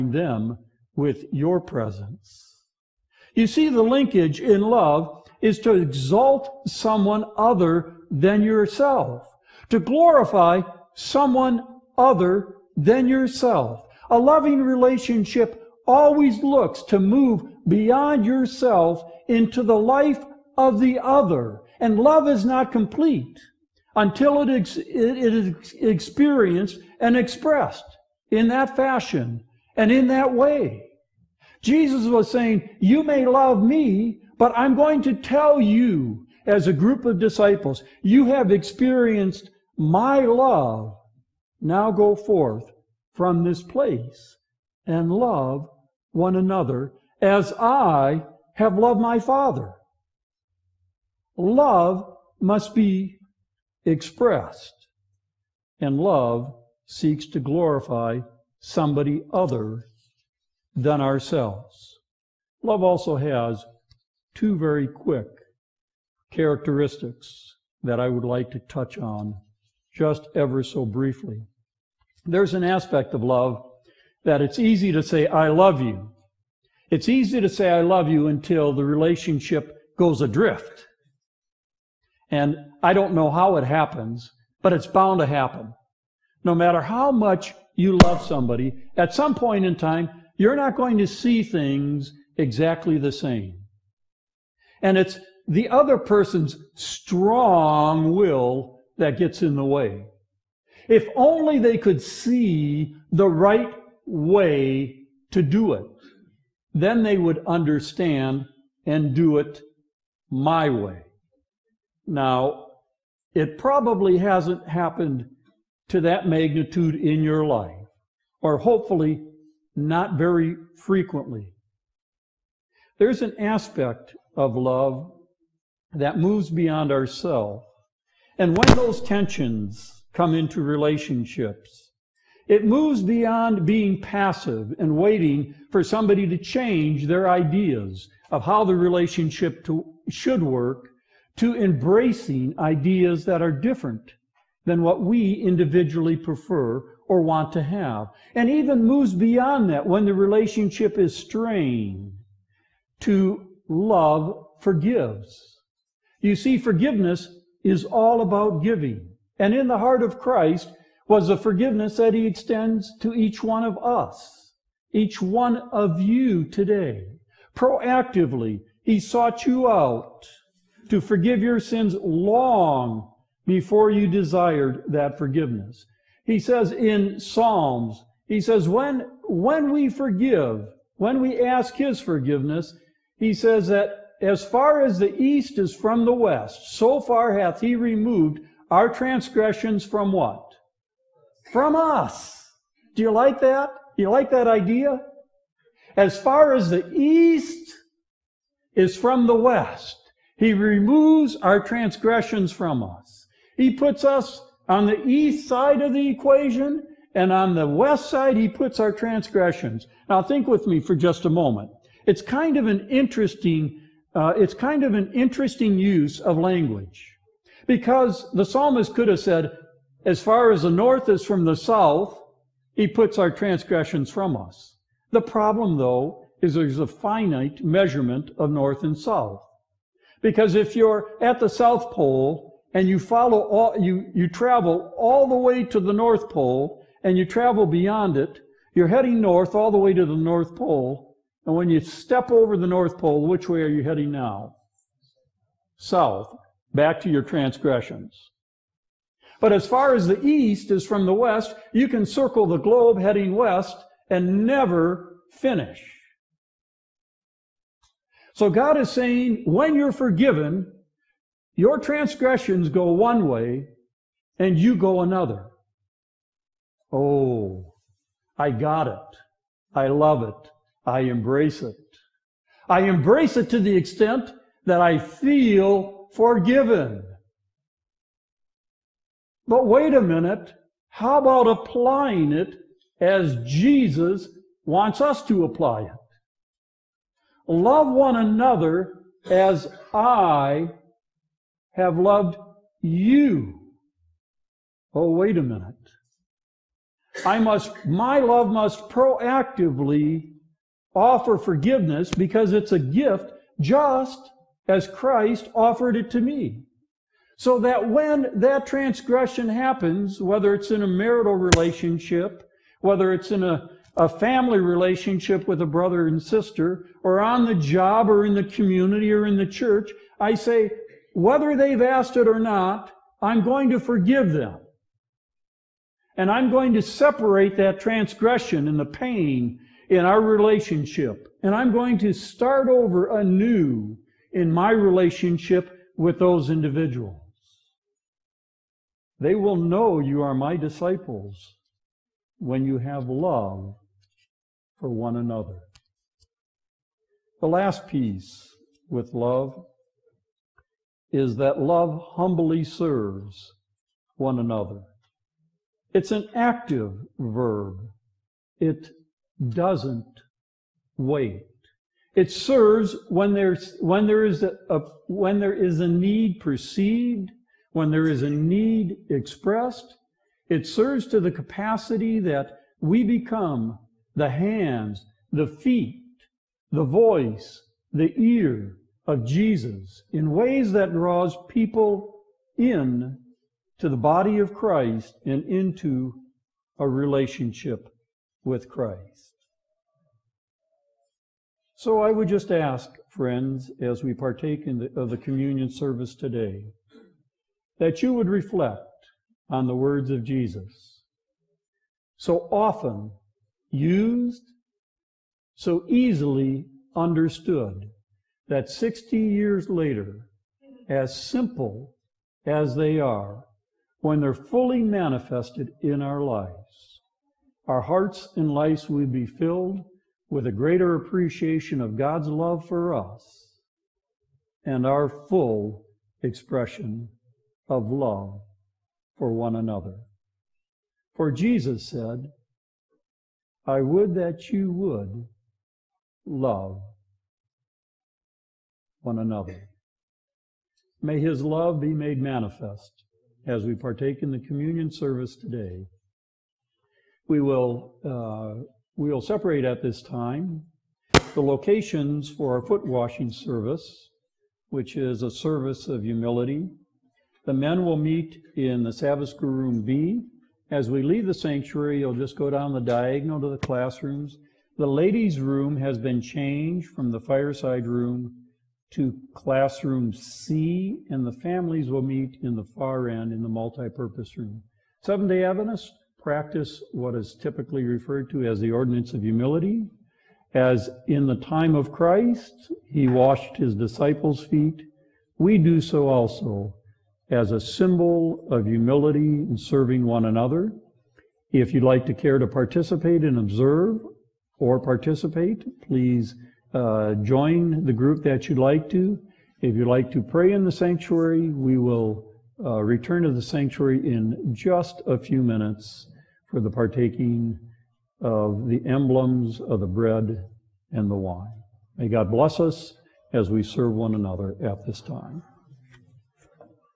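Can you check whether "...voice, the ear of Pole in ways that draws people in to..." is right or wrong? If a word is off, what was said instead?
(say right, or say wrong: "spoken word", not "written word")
wrong: "Jesus", not "Pole".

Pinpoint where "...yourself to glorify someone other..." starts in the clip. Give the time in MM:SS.
00:08.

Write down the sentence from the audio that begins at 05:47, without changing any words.
The last piece with love is that love humbly serves one another.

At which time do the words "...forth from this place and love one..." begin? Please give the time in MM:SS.
00:42.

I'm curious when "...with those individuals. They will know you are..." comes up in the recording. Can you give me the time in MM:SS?
05:35.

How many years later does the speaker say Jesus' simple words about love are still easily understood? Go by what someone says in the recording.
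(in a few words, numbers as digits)
60.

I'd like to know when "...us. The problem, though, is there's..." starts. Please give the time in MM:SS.
03:44.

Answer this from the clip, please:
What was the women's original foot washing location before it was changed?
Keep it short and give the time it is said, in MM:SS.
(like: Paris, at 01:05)
Fireside room, at 07:47.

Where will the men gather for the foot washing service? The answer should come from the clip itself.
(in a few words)
Sabbath school room B.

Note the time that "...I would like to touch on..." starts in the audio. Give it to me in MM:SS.
01:08.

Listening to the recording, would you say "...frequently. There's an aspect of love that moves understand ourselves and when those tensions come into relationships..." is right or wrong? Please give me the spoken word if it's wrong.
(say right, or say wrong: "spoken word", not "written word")
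wrong: "beyond", not "understand".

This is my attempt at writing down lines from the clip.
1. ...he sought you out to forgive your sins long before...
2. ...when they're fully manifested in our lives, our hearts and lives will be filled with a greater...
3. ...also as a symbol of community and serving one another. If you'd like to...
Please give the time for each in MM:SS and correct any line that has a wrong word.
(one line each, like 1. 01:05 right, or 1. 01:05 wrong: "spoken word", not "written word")
1. 02:48 right
2. 06:54 right
3. 08:06 wrong: "humility", not "community".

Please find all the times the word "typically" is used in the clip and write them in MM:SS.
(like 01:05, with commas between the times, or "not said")
07:57.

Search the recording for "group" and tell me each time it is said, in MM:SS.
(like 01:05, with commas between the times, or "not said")
00:36, 08:17.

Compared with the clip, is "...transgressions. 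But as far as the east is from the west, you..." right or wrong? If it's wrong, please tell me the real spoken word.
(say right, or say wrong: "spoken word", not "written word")
right.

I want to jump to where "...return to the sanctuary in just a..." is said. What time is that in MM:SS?
08:22.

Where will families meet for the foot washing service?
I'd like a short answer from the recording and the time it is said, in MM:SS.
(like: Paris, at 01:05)
Multipurpose room, at 07:53.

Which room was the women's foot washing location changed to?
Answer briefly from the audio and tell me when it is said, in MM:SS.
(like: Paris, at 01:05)
Classroom C, at 07:49.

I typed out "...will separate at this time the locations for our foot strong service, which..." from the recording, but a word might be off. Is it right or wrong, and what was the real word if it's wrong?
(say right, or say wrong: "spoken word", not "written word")
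wrong: "washing", not "strong".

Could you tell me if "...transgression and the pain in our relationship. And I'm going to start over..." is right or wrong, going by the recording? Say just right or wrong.
right.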